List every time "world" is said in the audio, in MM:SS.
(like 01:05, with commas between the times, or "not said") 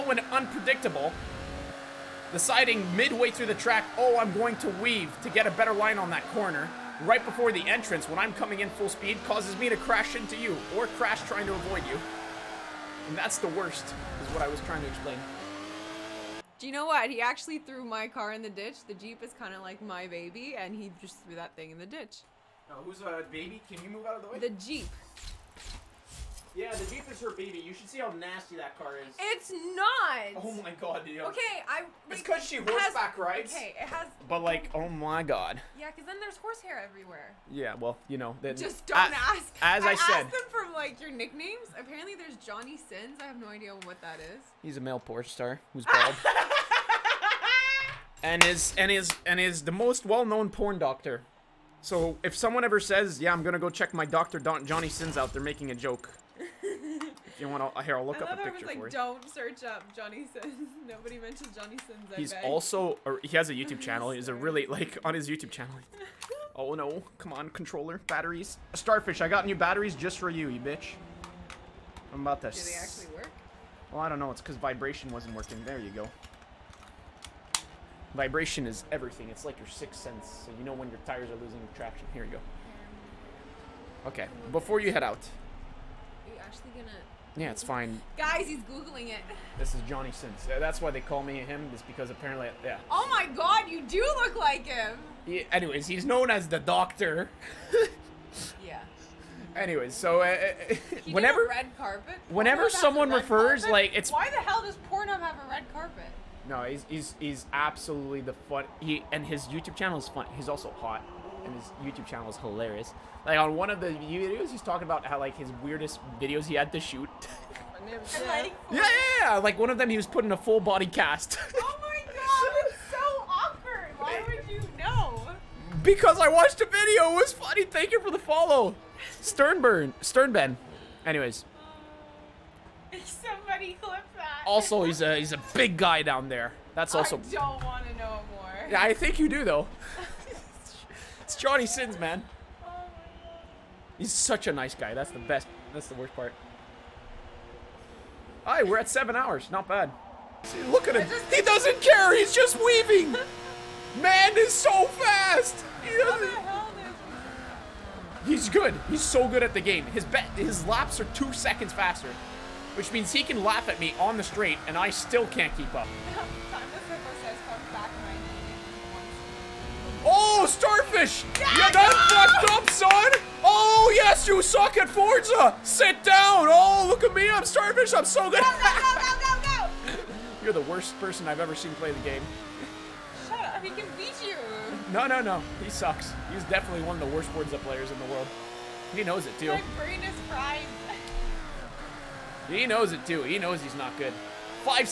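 03:08.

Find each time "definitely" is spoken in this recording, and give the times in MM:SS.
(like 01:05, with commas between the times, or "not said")
03:06.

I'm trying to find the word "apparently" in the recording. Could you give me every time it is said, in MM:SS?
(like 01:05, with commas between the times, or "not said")
00:41, 01:32.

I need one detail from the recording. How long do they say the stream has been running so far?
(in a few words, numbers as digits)
7 hours.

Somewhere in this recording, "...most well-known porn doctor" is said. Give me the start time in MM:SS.
00:49.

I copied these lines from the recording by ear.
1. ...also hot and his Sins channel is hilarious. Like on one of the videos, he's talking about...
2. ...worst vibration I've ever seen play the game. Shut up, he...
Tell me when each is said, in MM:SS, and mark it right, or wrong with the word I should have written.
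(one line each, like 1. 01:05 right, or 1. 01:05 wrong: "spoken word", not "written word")
1. 01:50 wrong: "YouTube", not "Sins"
2. 03:00 wrong: "person", not "vibration".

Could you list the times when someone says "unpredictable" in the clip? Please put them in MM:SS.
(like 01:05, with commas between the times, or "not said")
00:00.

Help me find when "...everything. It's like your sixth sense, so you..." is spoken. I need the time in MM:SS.
01:18.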